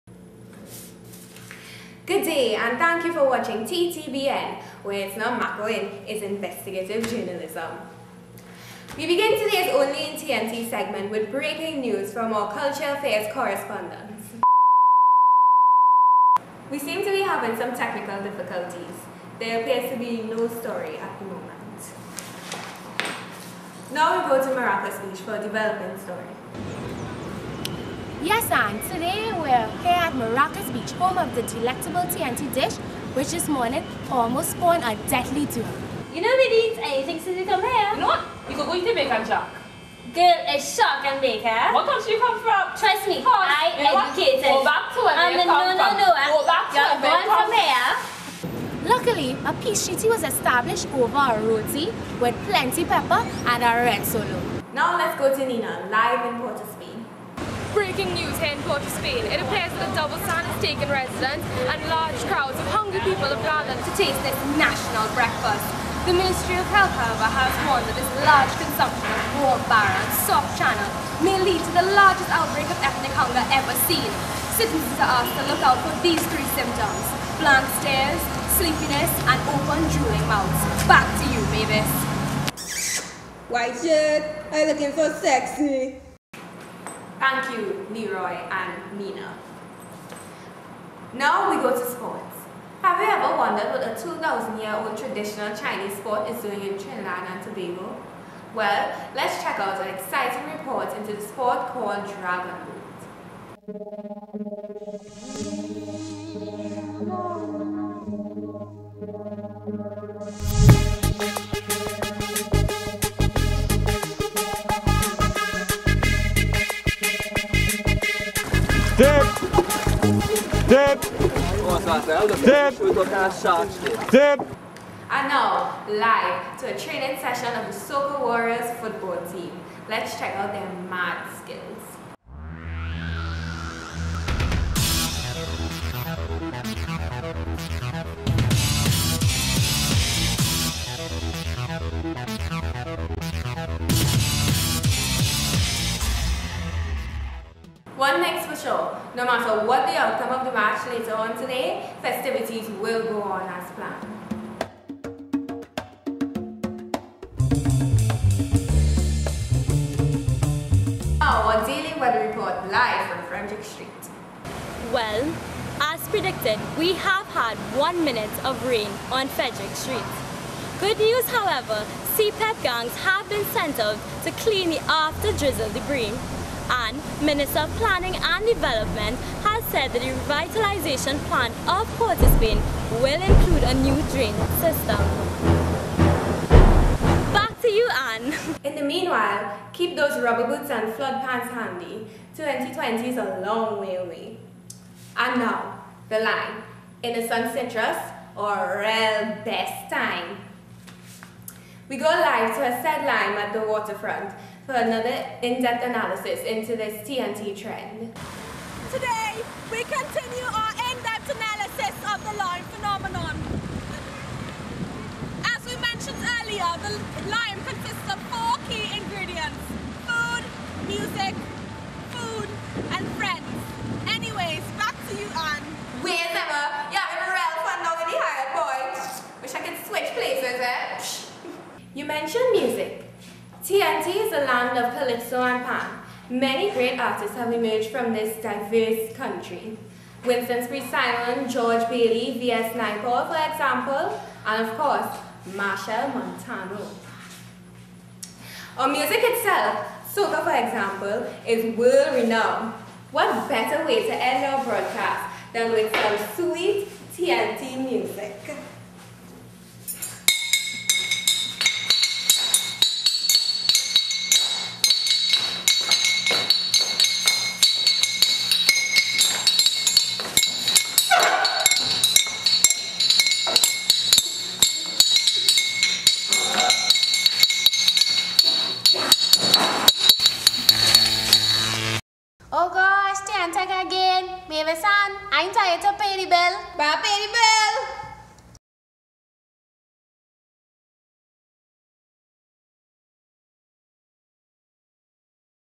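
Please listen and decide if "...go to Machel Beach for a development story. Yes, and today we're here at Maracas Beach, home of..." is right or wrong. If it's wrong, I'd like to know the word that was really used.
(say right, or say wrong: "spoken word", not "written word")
wrong: "Maracas", not "Machel".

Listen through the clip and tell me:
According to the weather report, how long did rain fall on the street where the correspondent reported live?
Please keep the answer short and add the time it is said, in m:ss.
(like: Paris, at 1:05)
1 minute, at 2:47.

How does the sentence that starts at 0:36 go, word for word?
You know we eat anything since you come here.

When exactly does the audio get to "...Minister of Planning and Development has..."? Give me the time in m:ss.
2:57.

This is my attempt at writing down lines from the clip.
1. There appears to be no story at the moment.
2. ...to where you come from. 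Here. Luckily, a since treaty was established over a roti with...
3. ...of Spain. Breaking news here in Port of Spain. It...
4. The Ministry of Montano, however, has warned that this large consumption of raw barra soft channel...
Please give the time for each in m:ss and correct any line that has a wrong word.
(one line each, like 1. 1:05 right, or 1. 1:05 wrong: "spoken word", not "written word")
1. 0:19 right
2. 0:46 wrong: "peace", not "since"
3. 0:56 right
4. 1:06 wrong: "Health", not "Montano".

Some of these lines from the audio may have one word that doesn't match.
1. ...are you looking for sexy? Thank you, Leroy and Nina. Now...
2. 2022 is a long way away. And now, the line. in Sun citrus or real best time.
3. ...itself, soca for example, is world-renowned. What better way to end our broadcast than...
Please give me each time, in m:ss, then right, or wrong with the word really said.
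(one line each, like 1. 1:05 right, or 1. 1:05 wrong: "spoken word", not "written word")
1. 1:24 right
2. 3:12 wrong: "2020", not "2022"
3. 4:09 right.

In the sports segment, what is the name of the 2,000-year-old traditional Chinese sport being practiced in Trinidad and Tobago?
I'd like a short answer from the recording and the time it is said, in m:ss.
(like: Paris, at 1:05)
Dragon Boat, at 1:42.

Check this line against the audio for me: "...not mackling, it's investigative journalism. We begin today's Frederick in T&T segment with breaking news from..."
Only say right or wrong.
wrong.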